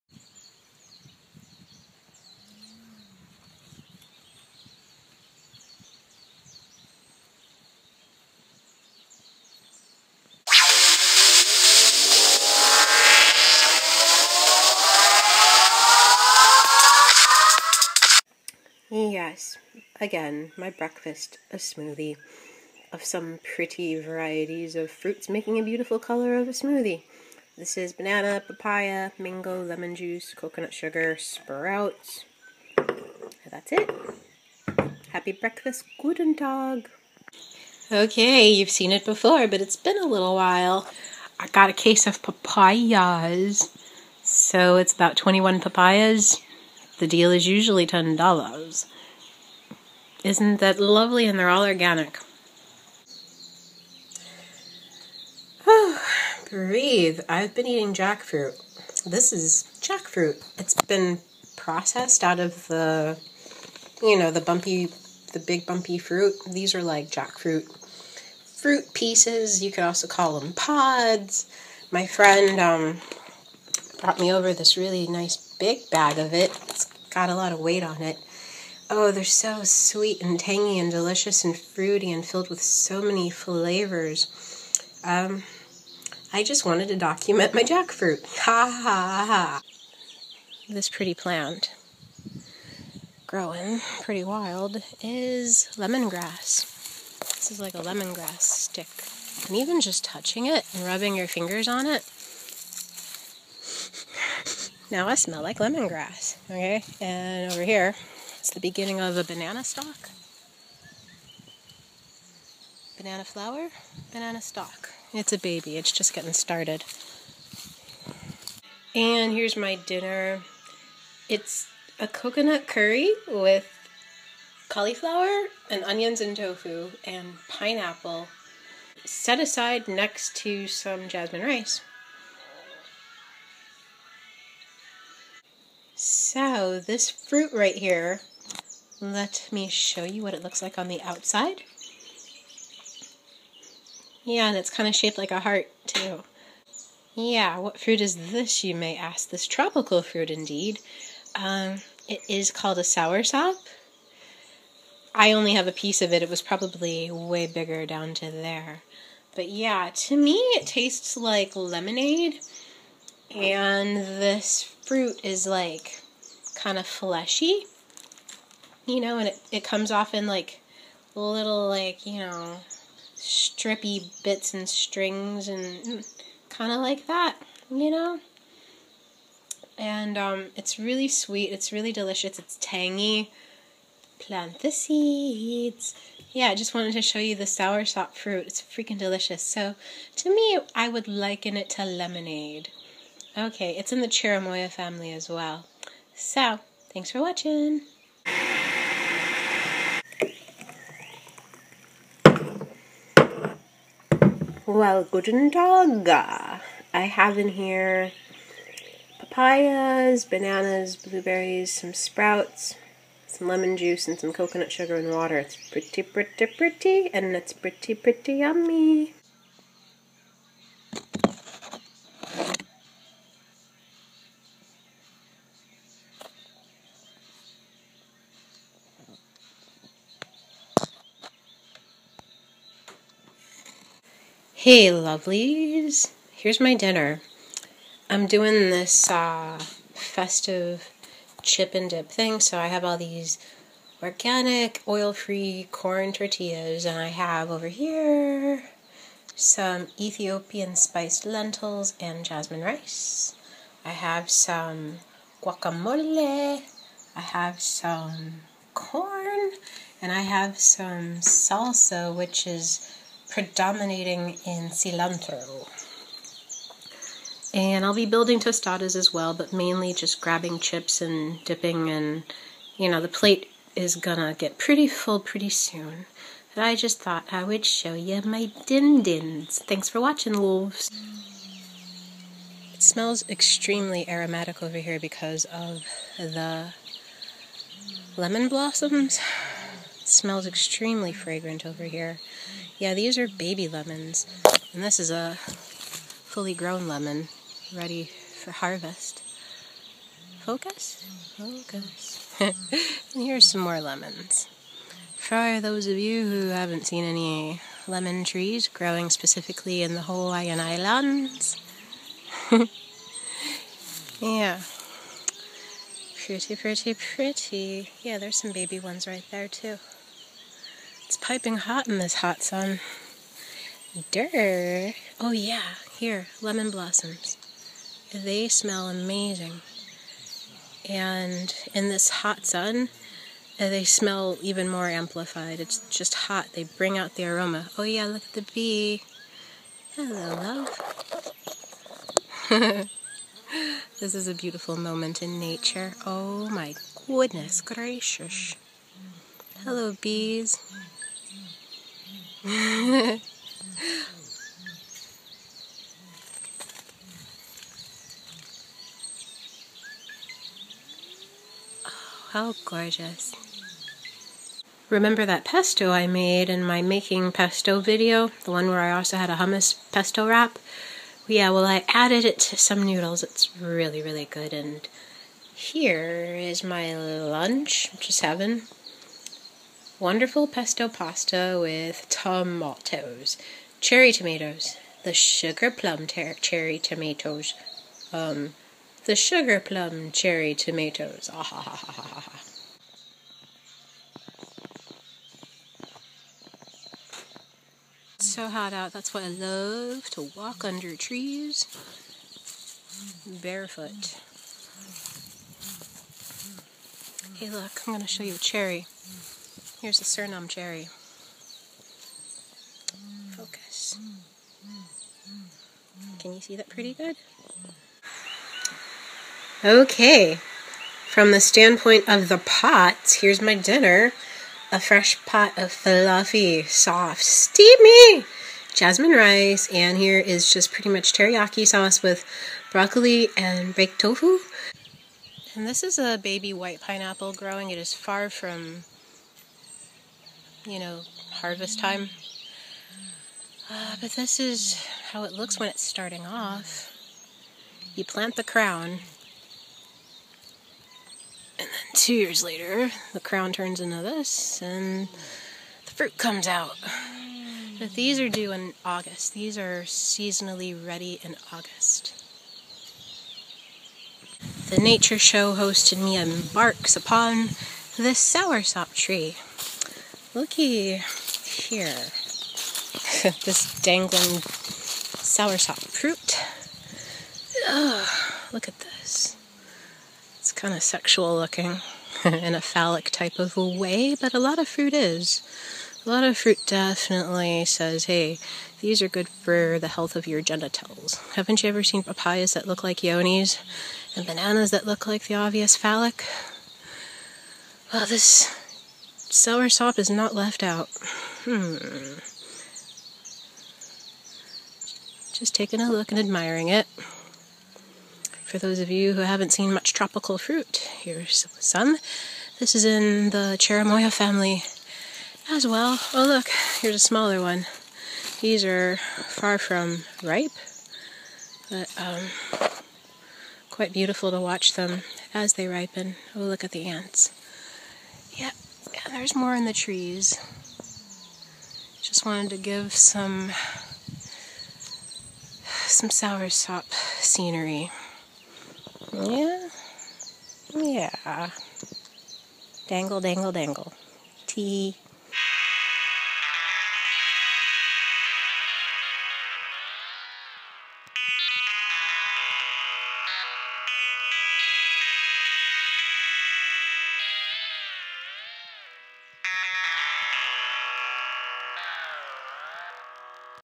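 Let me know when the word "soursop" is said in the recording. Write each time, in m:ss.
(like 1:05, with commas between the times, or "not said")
2:32, 3:07, 7:48, 7:55, 8:19, 8:56.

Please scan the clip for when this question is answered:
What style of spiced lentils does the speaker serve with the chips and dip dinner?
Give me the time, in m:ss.
4:09.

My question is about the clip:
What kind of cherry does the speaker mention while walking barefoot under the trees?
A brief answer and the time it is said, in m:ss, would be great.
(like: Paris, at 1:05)
Suriname cherry, at 6:50.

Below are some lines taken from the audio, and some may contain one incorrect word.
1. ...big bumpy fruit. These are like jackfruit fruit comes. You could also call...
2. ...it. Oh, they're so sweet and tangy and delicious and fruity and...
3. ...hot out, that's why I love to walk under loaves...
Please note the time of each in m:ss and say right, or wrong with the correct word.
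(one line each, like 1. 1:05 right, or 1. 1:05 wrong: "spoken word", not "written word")
1. 1:05 wrong: "pieces", not "comes"
2. 1:18 right
3. 6:38 wrong: "trees", not "loaves".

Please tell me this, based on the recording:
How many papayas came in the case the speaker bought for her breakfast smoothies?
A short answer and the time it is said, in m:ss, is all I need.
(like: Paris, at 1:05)
21, at 0:45.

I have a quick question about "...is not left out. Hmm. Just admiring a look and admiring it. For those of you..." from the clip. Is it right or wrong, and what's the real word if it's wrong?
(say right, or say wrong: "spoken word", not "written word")
wrong: "taking", not "admiring".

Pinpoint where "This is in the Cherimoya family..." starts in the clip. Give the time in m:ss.
8:32.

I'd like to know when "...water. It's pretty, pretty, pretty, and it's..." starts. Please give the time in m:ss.
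3:35.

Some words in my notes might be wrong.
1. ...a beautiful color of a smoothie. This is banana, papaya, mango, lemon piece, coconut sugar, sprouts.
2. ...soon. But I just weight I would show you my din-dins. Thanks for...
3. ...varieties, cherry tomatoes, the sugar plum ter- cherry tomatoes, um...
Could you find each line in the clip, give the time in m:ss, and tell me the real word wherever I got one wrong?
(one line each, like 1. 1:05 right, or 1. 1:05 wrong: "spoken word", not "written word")
1. 0:25 wrong: "juice", not "piece"
2. 4:35 wrong: "thought", not "weight"
3. 6:22 wrong: "tomatoes", not "varieties".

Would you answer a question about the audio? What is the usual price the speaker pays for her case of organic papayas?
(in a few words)
$10.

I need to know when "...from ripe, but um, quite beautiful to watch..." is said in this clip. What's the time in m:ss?
8:39.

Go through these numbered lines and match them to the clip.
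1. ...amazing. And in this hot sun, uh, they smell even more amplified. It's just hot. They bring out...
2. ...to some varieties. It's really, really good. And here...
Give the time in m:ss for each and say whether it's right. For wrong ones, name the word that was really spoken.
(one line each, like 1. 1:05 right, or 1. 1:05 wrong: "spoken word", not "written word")
1. 5:28 right
2. 6:12 wrong: "noodles", not "varieties".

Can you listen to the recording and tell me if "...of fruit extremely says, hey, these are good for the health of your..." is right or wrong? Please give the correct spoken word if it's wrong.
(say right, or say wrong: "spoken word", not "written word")
wrong: "definitely", not "extremely".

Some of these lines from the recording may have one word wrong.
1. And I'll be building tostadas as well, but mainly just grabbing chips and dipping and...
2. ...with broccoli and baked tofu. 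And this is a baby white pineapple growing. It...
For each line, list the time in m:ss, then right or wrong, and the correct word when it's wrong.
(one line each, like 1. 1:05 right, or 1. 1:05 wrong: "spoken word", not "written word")
1. 4:27 right
2. 7:12 right.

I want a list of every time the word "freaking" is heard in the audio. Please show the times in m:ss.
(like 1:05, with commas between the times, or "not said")
3:08.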